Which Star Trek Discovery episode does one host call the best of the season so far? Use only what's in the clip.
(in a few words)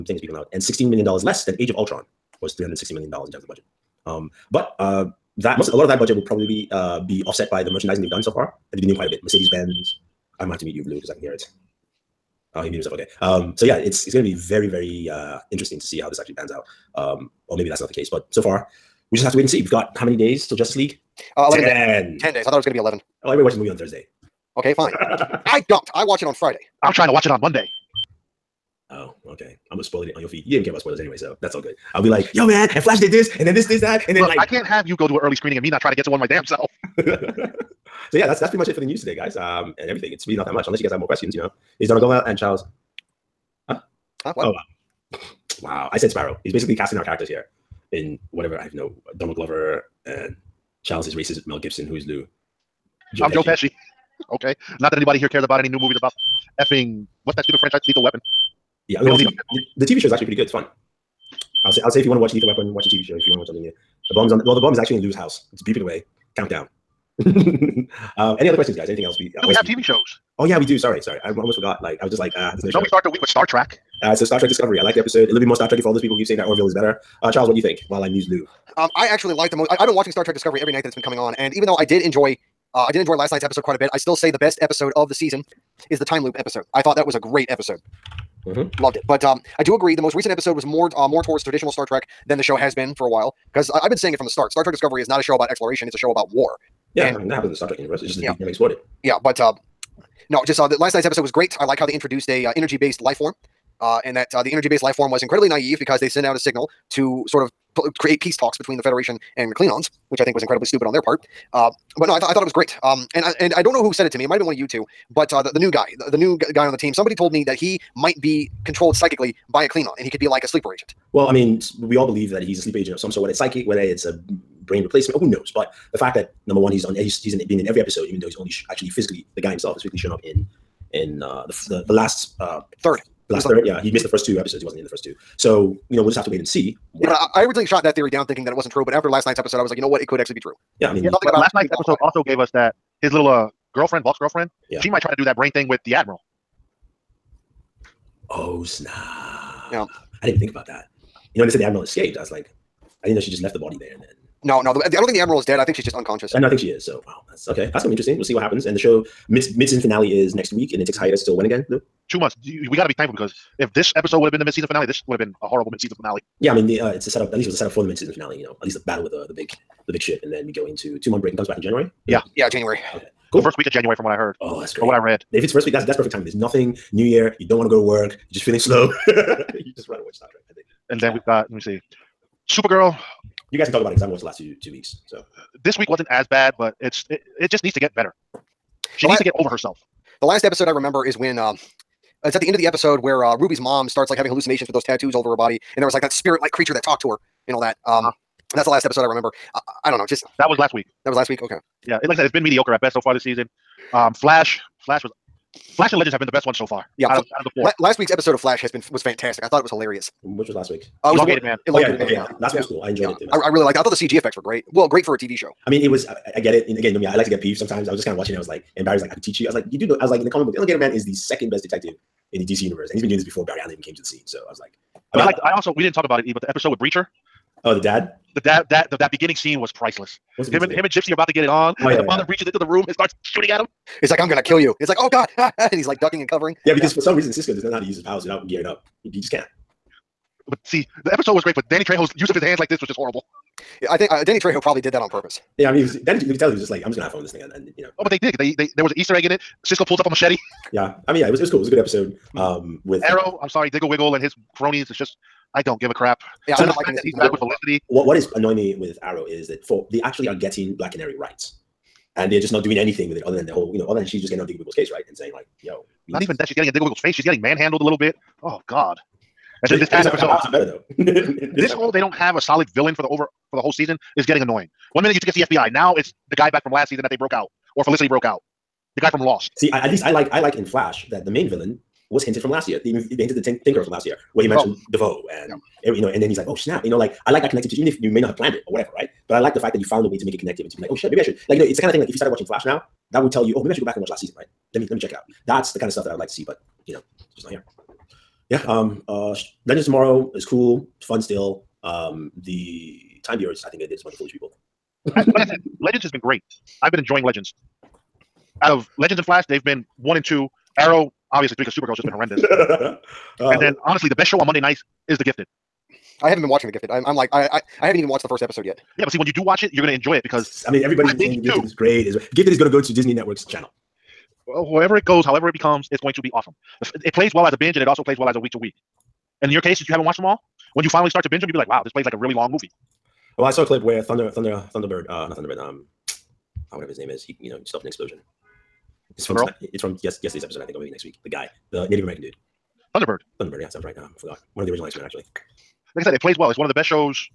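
The time loop episode.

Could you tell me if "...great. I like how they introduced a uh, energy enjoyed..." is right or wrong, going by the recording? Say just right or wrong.
wrong.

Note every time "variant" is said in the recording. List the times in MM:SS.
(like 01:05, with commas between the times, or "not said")
not said.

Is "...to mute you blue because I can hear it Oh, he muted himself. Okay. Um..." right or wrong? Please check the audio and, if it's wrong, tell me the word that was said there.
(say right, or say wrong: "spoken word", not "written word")
right.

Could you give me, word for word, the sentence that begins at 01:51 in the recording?
Uh, but no, I thought I thought it was great.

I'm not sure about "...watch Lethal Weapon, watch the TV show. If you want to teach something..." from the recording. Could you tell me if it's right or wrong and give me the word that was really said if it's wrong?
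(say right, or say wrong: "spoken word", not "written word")
wrong: "watch", not "teach".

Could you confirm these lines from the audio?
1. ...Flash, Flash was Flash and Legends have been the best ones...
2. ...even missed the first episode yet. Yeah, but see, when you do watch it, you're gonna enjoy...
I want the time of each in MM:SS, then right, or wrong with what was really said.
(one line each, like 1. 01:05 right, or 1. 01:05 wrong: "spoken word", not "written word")
1. 03:24 right
2. 05:17 wrong: "watched", not "missed".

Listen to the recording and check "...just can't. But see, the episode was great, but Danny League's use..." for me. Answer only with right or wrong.
wrong.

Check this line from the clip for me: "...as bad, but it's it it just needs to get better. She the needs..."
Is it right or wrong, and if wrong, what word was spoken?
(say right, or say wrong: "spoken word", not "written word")
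right.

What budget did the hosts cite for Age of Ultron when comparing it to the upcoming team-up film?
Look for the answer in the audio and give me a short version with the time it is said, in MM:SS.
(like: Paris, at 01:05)
$360 million, at 00:02.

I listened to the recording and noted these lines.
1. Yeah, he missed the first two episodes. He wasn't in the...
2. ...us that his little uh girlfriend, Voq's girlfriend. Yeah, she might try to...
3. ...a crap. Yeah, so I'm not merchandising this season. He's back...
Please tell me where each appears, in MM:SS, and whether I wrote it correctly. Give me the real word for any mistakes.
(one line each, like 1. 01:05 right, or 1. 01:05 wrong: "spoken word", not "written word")
1. 02:13 right
2. 02:22 right
3. 04:15 wrong: "liking", not "merchandising".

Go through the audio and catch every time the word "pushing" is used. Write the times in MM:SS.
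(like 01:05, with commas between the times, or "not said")
not said.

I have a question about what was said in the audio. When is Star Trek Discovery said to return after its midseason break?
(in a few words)
First week of January.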